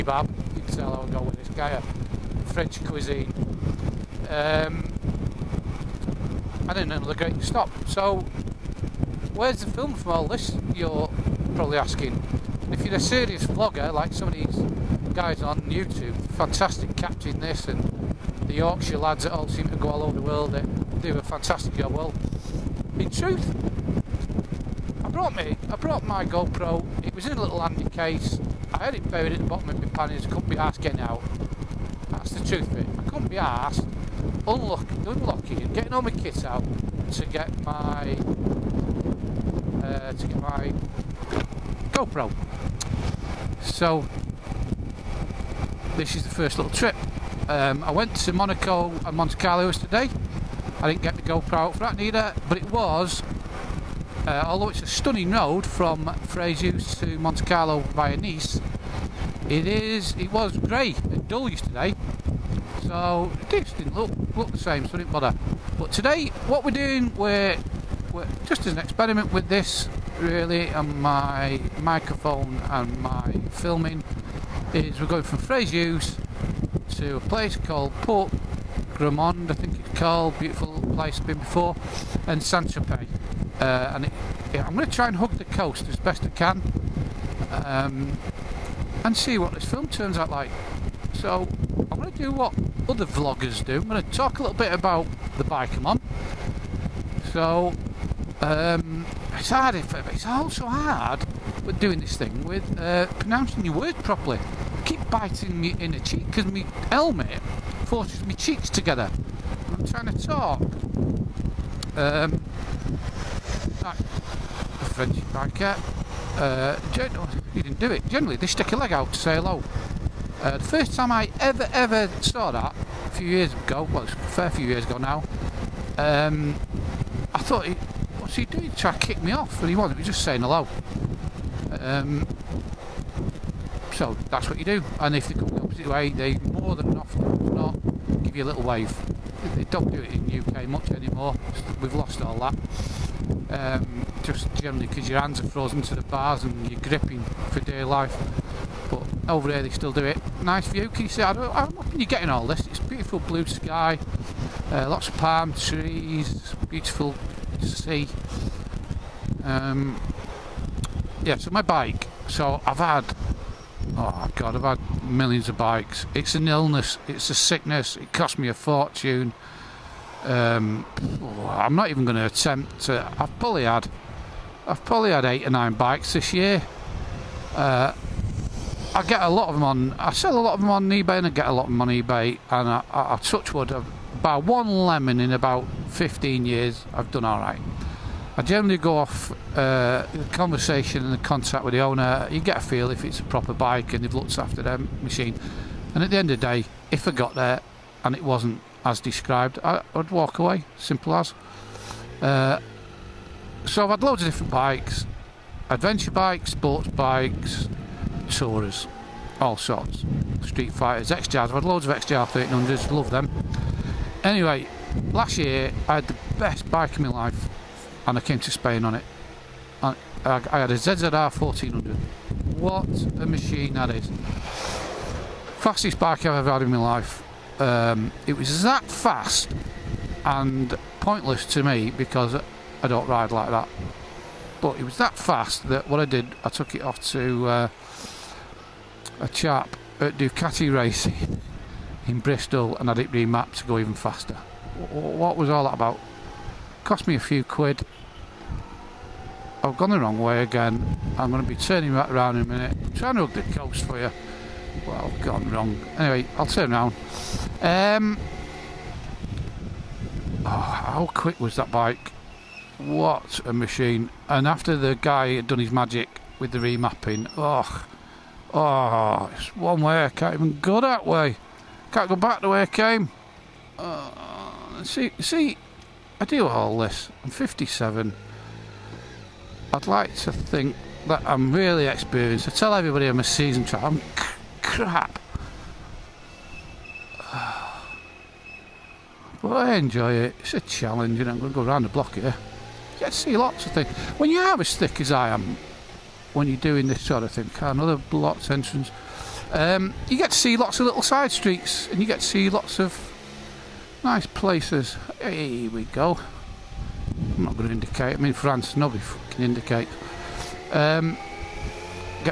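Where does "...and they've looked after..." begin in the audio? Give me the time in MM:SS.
03:13.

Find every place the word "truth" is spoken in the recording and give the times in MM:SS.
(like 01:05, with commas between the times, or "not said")
00:23, 00:32.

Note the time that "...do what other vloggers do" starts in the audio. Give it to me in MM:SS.
01:32.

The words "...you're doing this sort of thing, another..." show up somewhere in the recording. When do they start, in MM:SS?
04:56.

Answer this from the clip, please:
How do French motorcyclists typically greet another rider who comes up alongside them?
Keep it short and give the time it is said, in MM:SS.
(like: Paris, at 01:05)
Stick a leg out, at 01:58.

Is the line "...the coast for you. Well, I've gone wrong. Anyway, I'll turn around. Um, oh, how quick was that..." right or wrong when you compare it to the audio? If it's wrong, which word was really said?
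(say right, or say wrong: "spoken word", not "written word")
right.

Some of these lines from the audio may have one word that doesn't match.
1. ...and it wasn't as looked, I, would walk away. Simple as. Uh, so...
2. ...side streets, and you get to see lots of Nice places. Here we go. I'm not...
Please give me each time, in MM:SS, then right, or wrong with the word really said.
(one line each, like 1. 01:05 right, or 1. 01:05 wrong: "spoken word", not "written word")
1. 03:18 wrong: "described", not "looked"
2. 05:01 right.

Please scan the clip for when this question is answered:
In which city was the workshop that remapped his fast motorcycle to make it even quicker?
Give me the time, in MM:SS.
04:02.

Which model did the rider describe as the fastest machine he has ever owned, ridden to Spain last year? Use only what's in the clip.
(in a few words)
ZZR 1400.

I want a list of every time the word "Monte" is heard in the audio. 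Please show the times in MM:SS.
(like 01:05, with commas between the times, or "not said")
00:49, 00:57.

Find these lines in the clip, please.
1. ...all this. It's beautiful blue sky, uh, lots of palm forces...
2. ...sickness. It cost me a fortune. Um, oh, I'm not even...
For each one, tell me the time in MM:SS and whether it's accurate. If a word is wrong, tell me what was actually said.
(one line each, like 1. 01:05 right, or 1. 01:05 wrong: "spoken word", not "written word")
1. 02:32 wrong: "trees", not "forces"
2. 02:47 right.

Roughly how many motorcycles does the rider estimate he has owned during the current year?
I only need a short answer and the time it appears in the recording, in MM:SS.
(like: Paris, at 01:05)
8 or 9, at 02:55.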